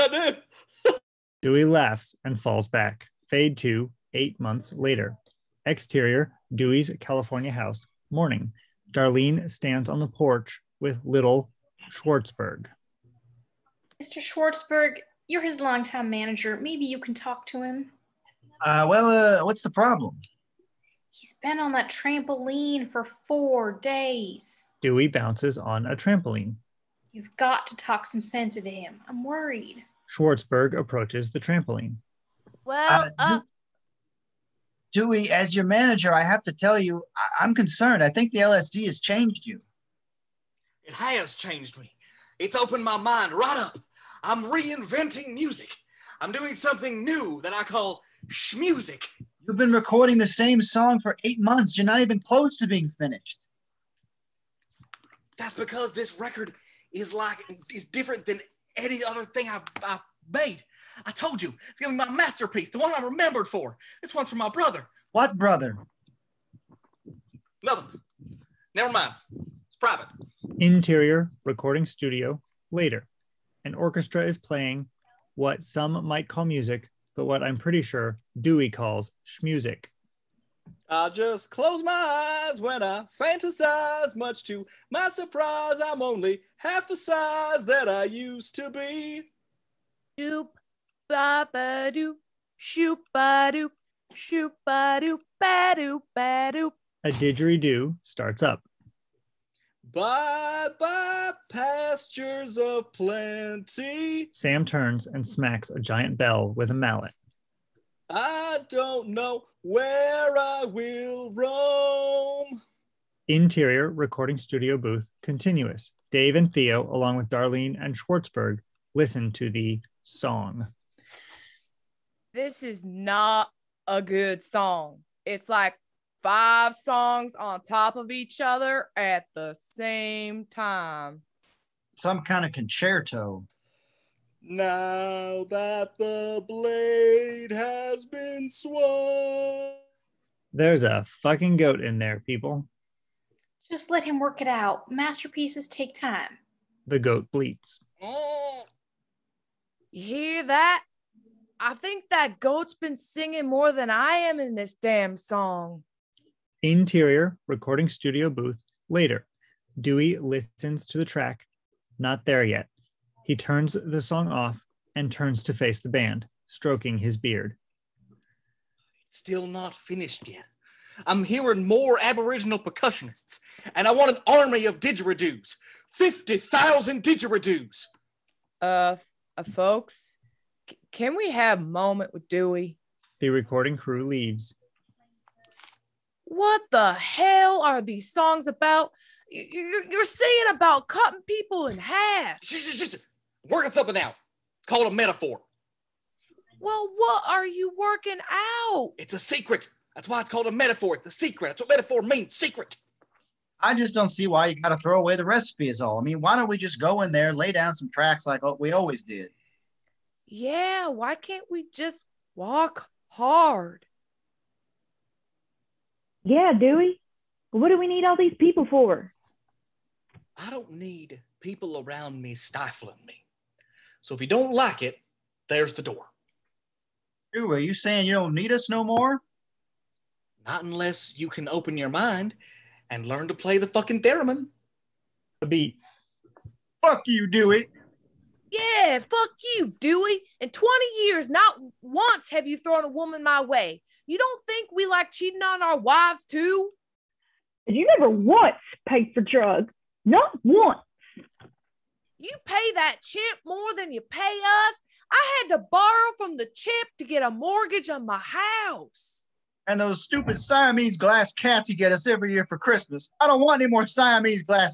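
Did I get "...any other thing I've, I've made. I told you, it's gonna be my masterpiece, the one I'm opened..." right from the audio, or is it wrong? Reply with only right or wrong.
wrong.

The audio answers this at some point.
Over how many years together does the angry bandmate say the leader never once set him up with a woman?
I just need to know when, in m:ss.
4:00.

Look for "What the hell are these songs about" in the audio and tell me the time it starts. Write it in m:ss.
3:06.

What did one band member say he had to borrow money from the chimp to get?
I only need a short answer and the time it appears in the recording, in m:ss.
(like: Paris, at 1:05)
A mortgage, at 4:17.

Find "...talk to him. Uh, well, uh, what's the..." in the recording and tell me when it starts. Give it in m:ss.
0:17.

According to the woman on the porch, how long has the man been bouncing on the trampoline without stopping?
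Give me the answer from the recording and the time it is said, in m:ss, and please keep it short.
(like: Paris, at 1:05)
4 days, at 0:23.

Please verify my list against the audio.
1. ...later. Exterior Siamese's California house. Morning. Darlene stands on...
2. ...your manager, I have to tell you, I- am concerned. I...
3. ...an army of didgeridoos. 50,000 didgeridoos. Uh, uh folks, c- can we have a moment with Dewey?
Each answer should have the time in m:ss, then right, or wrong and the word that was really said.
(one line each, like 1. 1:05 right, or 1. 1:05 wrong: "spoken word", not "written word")
1. 0:04 wrong: "Dewey", not "Siamese"
2. 0:35 right
3. 2:54 right.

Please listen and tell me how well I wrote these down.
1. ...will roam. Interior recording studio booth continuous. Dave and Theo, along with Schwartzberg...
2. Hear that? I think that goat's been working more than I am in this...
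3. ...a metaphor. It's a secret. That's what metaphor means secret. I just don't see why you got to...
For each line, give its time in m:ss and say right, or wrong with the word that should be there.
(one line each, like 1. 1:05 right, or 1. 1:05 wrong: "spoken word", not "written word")
1. 1:50 wrong: "Darlene", not "Schwartzberg"
2. 2:29 wrong: "singing", not "working"
3. 3:20 right.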